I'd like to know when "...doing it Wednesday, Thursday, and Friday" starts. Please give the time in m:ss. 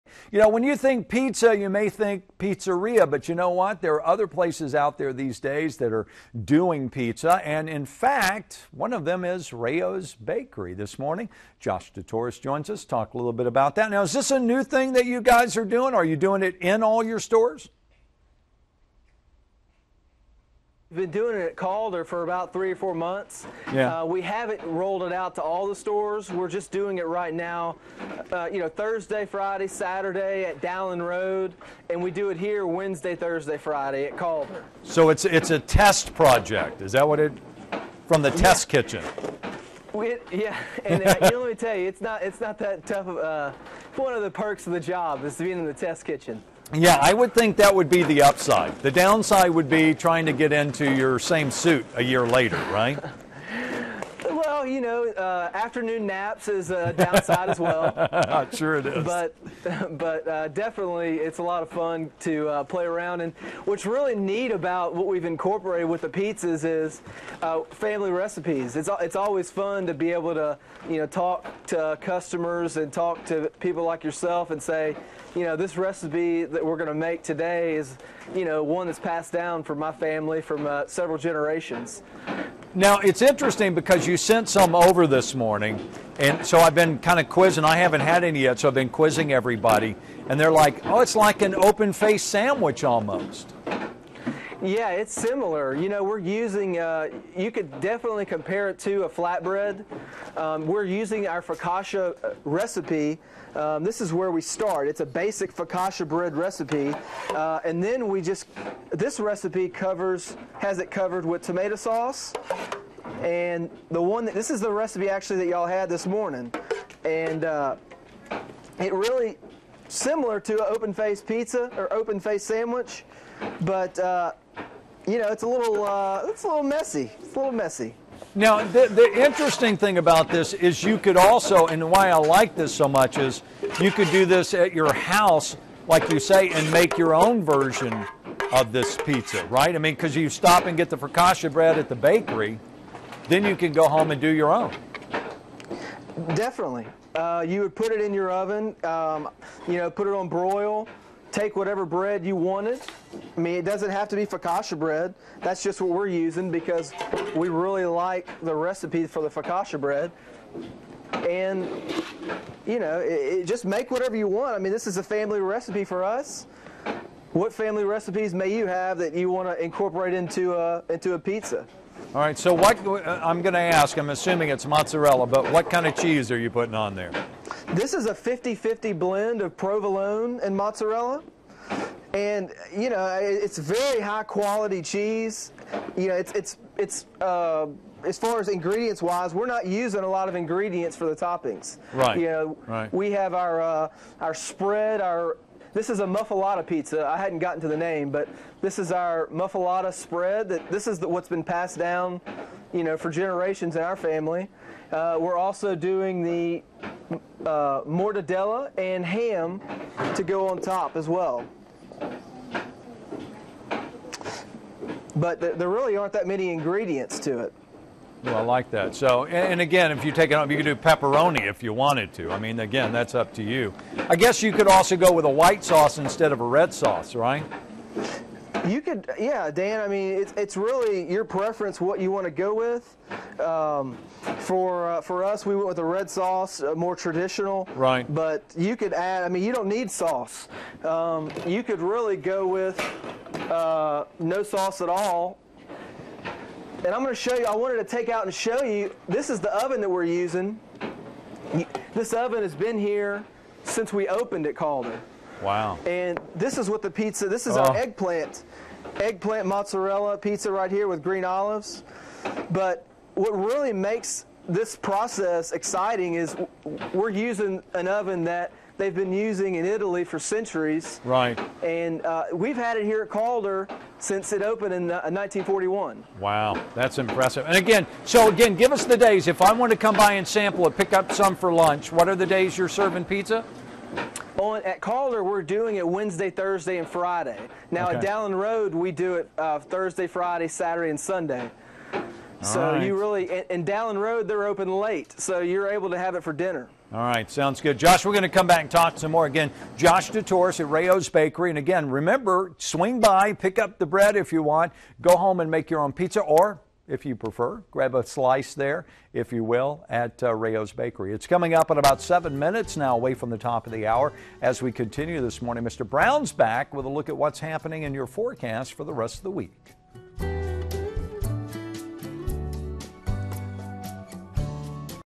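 4:45.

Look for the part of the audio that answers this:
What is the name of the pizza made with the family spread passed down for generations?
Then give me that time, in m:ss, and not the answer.
3:16.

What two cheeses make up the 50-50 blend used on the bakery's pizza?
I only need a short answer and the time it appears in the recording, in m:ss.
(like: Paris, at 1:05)
Provolone and mozzarella, at 2:59.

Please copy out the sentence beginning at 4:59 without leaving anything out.
Again, Josh DeTorres at Rao's Bakery.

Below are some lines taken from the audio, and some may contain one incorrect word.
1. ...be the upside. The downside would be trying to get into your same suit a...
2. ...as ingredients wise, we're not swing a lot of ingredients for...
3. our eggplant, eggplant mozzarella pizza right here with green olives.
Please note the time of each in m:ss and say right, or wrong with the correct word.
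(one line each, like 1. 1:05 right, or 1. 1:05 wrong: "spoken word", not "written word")
1. 0:47 right
2. 3:08 wrong: "using", not "swing"
3. 4:17 right.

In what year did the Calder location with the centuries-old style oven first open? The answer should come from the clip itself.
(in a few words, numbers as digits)
1941.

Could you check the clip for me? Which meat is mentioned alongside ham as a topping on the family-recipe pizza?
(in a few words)
Mortadella.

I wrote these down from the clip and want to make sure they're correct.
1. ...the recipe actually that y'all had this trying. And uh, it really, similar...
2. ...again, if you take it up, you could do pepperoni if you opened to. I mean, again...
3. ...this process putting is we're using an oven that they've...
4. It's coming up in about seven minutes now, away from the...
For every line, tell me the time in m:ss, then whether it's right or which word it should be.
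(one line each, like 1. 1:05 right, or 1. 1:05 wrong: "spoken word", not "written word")
1. 1:54 wrong: "morning", not "trying"
2. 3:39 wrong: "wanted", not "opened"
3. 4:24 wrong: "exciting", not "putting"
4. 5:11 right.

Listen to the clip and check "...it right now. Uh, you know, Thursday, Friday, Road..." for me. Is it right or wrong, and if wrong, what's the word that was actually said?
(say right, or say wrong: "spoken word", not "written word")
wrong: "Saturday", not "Road".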